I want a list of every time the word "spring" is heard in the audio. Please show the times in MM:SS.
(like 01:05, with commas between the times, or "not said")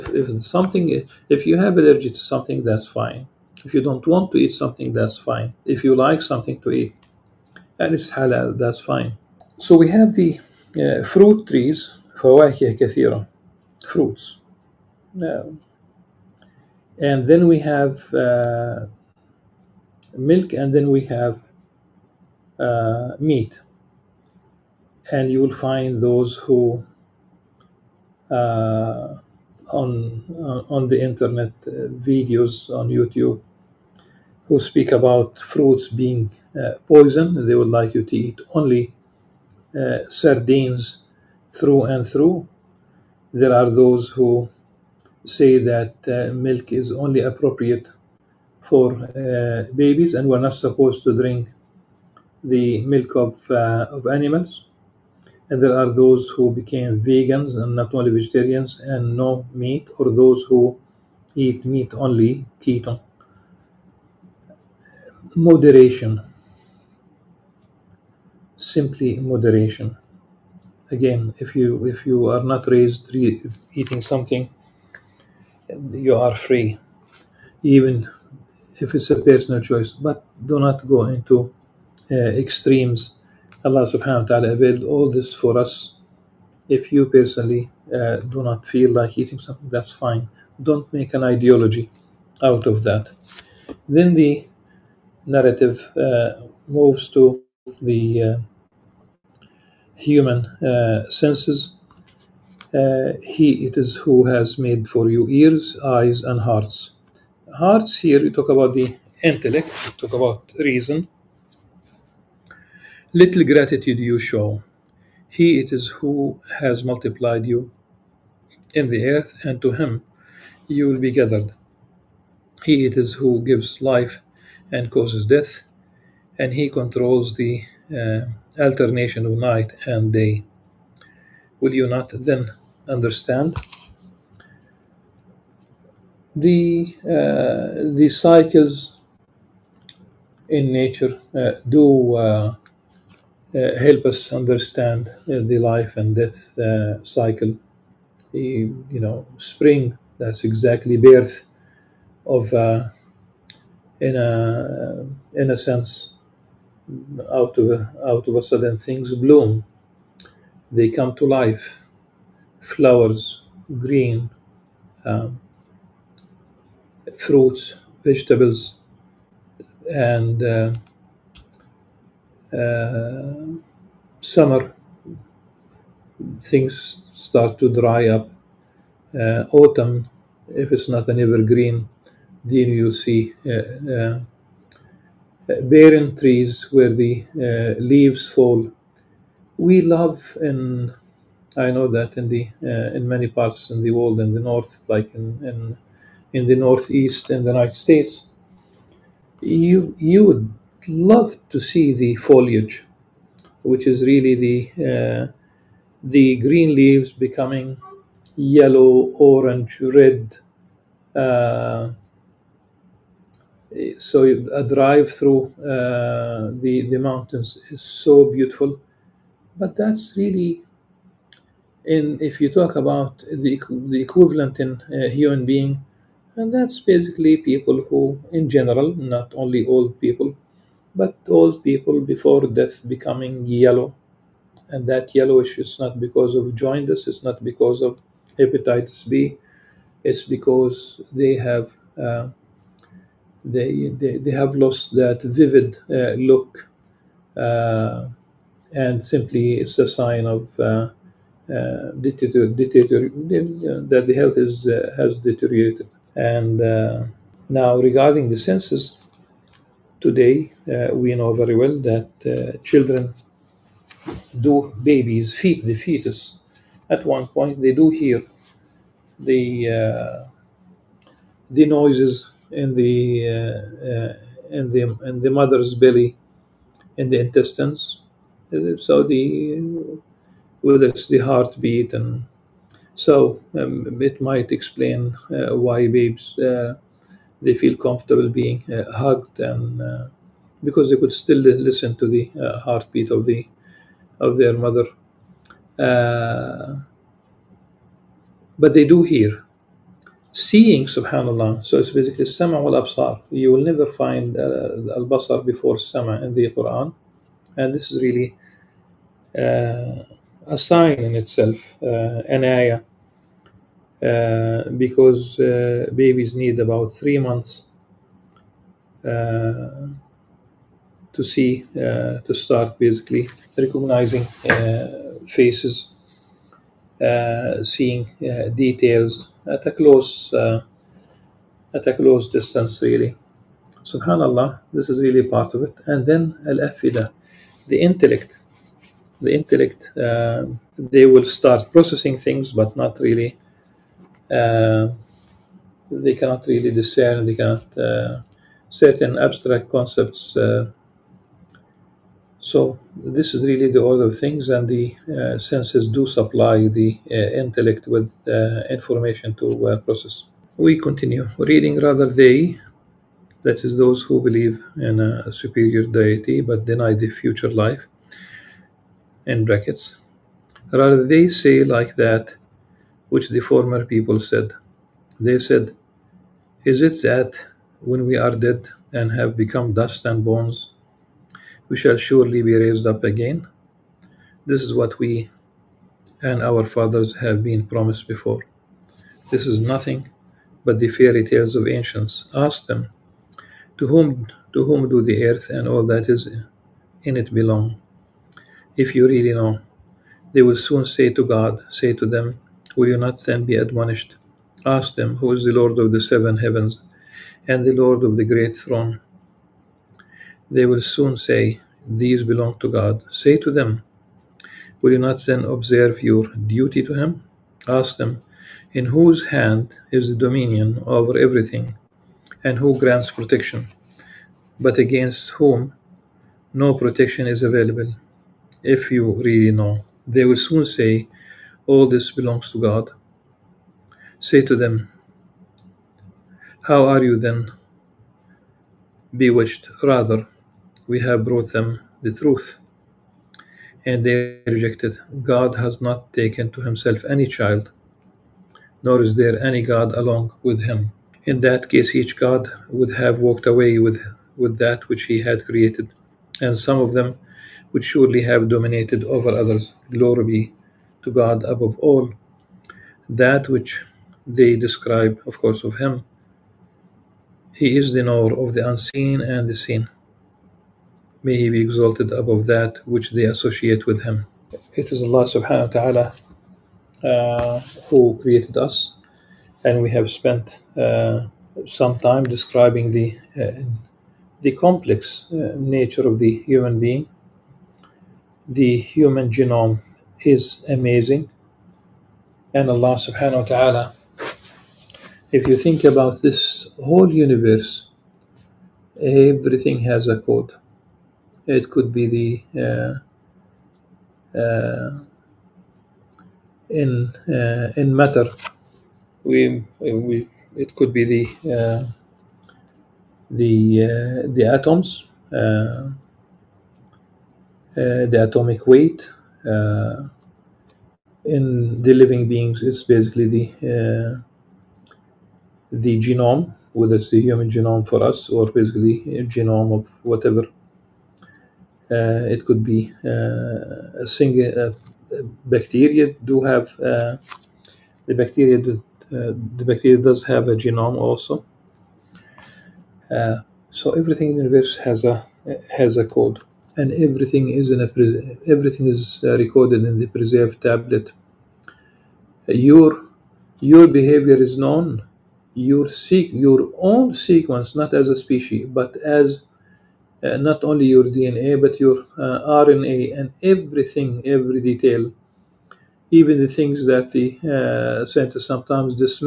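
02:29.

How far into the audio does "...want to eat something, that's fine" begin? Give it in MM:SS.
00:04.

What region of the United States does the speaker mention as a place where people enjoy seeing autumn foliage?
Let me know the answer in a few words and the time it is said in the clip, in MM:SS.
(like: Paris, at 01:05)
the northeast, at 03:16.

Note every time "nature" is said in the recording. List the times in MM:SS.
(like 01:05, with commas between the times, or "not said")
02:20, 08:05.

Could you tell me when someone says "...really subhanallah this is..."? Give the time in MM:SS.
05:32.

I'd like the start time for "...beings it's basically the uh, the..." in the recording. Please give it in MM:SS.
08:42.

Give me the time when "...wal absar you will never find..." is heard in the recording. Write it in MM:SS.
05:02.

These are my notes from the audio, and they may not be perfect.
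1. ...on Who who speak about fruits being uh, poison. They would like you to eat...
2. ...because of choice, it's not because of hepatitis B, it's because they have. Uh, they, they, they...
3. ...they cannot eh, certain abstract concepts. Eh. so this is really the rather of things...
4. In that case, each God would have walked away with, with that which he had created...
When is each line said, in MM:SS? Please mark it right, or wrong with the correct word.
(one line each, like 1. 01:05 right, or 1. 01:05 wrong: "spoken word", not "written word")
1. 00:32 wrong: "YouTube", not "Who"
2. 03:55 wrong: "jaundice", not "choice"
3. 05:47 wrong: "order", not "rather"
4. 07:31 right.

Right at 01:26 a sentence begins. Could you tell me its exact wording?
If you personally uh, do not feel like eating something, that's fine.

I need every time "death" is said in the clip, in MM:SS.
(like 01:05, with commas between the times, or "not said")
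02:05, 02:26, 03:52.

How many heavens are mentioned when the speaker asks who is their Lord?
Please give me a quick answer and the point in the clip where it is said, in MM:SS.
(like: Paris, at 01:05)
7, at 06:45.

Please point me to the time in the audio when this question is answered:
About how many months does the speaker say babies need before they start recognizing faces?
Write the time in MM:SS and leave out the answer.
05:16.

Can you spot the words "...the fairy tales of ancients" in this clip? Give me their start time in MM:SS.
06:30.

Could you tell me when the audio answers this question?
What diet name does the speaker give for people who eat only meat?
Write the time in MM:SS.
01:02.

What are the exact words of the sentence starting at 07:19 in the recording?
Rather, we have brought them the truth.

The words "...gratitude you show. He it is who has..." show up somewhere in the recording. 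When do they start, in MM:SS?
01:53.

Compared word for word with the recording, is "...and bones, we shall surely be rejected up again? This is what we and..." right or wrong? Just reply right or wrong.
wrong.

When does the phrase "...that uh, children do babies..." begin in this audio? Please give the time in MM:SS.
04:21.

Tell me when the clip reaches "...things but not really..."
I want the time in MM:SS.
05:42.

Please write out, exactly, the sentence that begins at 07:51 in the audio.
May He be exalted above that which they associate with Him.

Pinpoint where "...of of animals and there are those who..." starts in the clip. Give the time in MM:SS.
00:53.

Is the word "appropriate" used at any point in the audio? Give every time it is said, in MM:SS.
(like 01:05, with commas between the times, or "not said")
00:47.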